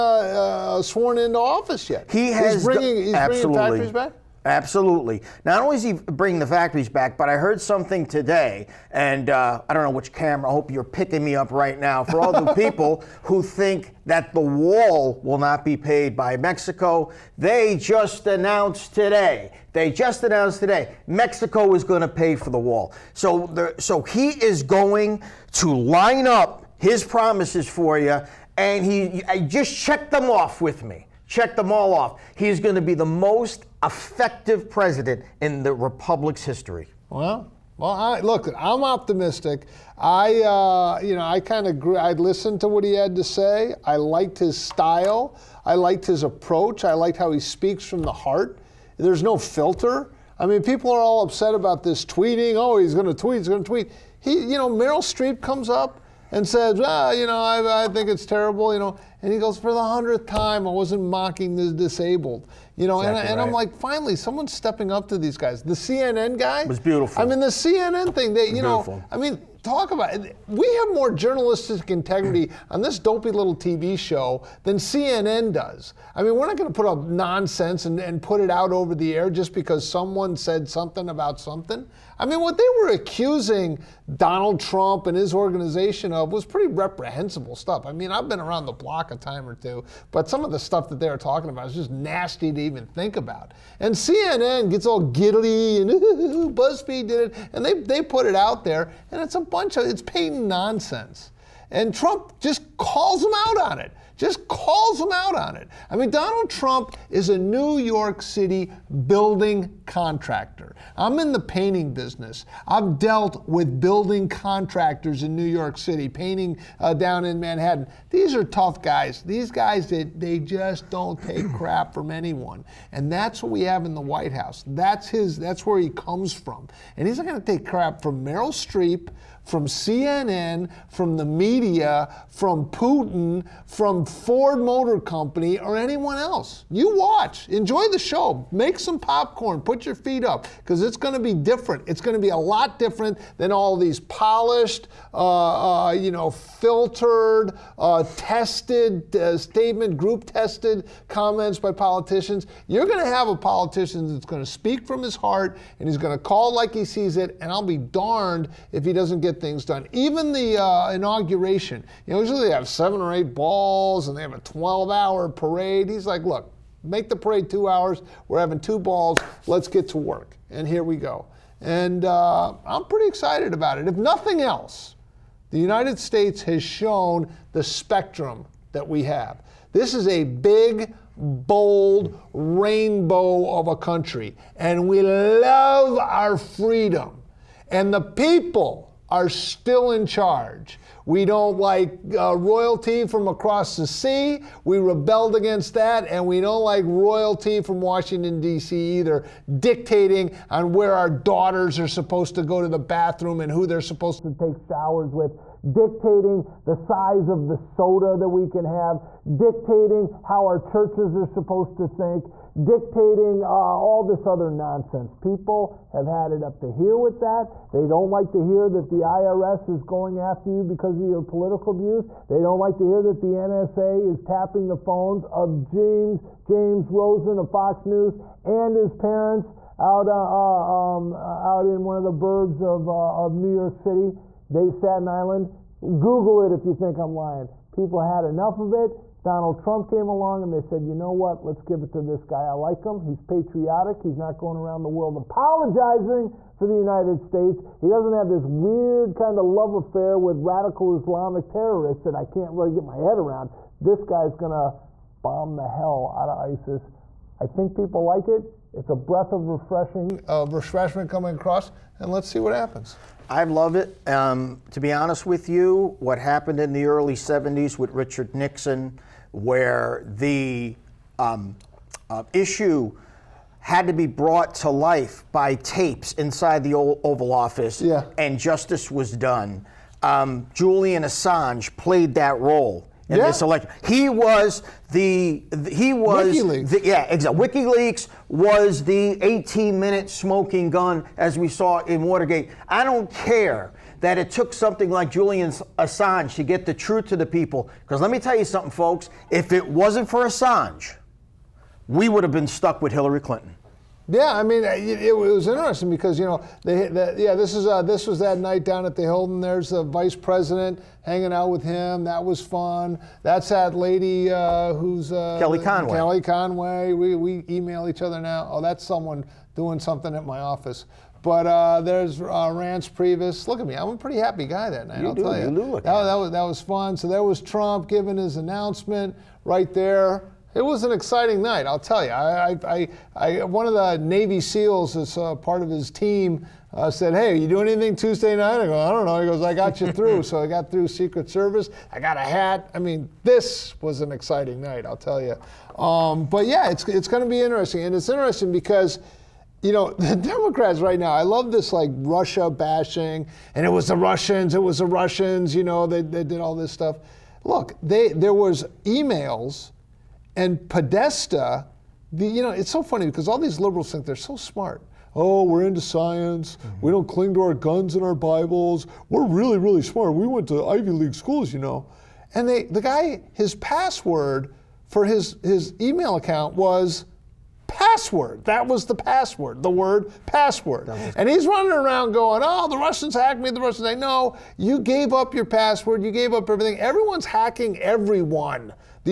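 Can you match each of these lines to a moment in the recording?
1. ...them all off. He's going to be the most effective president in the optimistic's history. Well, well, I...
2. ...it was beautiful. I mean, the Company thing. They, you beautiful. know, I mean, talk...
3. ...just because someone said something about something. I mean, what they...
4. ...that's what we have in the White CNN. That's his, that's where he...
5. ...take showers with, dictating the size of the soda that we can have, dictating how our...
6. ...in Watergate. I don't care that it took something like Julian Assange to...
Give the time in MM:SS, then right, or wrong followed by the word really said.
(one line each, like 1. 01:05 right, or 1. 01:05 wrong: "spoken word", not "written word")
1. 00:31 wrong: "republic", not "optimistic"
2. 01:06 wrong: "CNN", not "Company"
3. 01:19 right
4. 02:03 wrong: "House", not "CNN"
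5. 03:24 right
6. 04:51 right.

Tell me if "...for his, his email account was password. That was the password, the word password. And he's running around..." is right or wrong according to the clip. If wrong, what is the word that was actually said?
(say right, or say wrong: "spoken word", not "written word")
right.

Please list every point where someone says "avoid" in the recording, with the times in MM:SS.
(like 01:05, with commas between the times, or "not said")
not said.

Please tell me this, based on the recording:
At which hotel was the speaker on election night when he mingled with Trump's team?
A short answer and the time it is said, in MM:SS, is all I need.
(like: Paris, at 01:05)
the Hilton, at 05:08.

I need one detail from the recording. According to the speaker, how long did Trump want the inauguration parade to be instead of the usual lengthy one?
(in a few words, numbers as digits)
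2 hours.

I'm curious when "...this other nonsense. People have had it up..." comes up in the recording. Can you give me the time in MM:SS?
03:34.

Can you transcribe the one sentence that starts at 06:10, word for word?
We went to Ivy League schools, you know.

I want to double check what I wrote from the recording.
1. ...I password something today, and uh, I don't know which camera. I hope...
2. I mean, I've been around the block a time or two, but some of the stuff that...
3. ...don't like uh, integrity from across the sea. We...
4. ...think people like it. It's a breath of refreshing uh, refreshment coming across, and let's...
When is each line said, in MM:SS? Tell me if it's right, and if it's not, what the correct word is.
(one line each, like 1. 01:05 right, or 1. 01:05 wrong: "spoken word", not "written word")
1. 00:07 wrong: "heard", not "password"
2. 01:27 right
3. 03:11 wrong: "royalty", not "integrity"
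4. 04:17 right.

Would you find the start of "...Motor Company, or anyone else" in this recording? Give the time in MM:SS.
02:14.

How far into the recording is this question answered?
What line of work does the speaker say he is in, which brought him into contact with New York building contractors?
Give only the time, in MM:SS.
01:51.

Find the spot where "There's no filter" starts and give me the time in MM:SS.
00:48.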